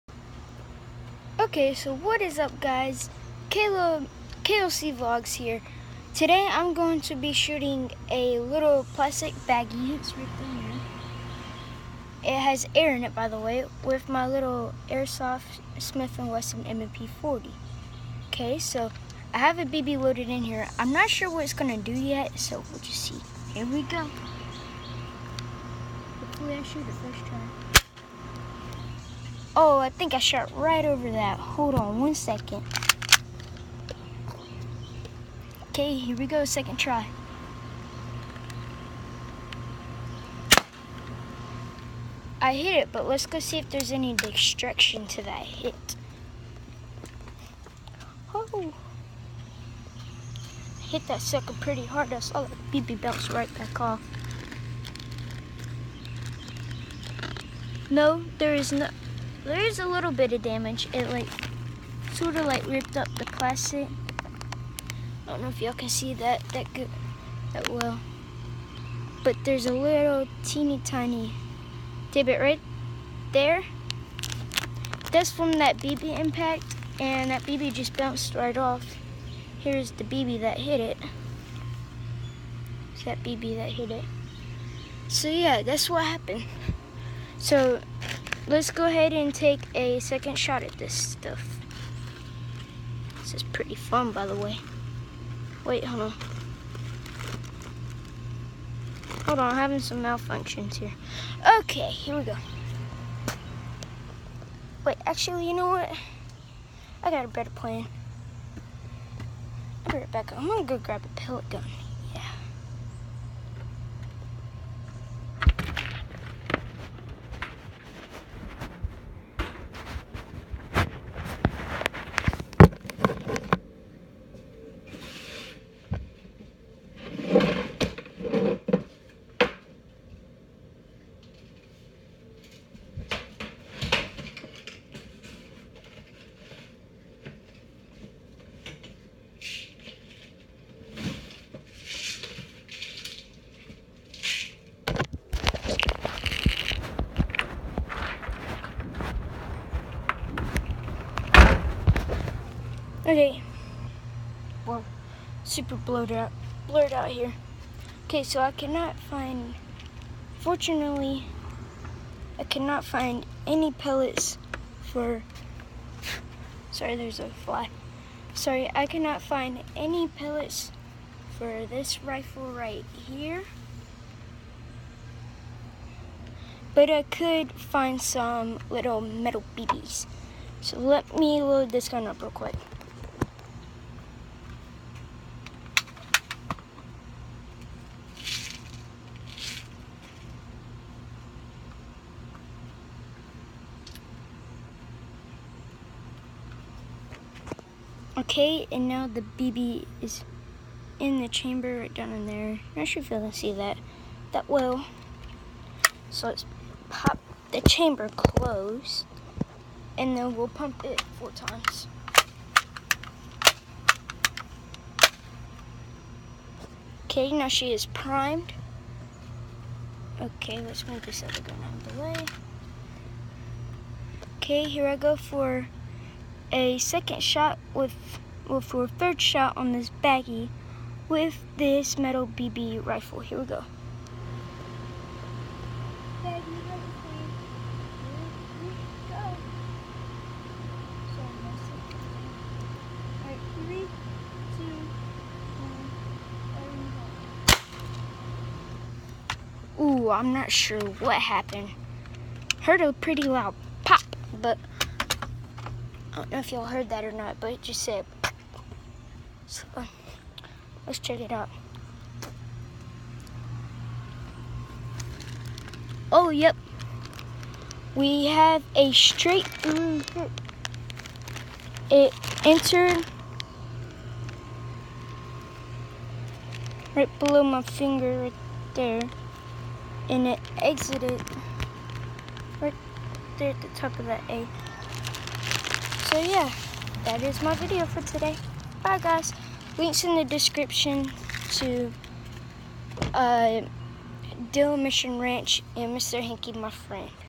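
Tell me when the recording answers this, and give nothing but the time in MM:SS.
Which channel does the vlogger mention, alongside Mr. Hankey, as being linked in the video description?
04:54.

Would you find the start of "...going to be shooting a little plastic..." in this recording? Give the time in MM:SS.
00:06.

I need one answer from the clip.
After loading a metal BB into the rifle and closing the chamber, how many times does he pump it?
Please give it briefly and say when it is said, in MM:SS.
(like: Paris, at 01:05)
4, at 03:31.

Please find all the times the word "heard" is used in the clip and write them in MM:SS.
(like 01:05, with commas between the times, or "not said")
04:12, 04:16.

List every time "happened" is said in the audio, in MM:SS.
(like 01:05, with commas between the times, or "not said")
01:26, 04:11.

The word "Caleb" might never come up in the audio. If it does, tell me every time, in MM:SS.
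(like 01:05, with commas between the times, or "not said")
00:03.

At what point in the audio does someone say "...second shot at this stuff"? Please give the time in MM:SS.
01:30.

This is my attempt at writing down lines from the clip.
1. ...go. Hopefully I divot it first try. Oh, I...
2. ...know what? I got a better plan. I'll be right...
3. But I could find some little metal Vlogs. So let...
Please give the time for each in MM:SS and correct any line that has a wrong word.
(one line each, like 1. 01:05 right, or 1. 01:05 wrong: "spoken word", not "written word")
1. 00:23 wrong: "shoot", not "divot"
2. 01:45 right
3. 02:56 wrong: "BBs", not "Vlogs".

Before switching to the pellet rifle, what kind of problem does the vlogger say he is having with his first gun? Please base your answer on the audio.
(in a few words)
malfunctions.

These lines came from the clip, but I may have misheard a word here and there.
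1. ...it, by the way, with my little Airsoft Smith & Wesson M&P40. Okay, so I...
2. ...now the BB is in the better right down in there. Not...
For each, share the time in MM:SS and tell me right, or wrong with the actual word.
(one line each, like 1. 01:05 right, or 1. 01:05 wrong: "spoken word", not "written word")
1. 00:13 right
2. 03:18 wrong: "chamber", not "better".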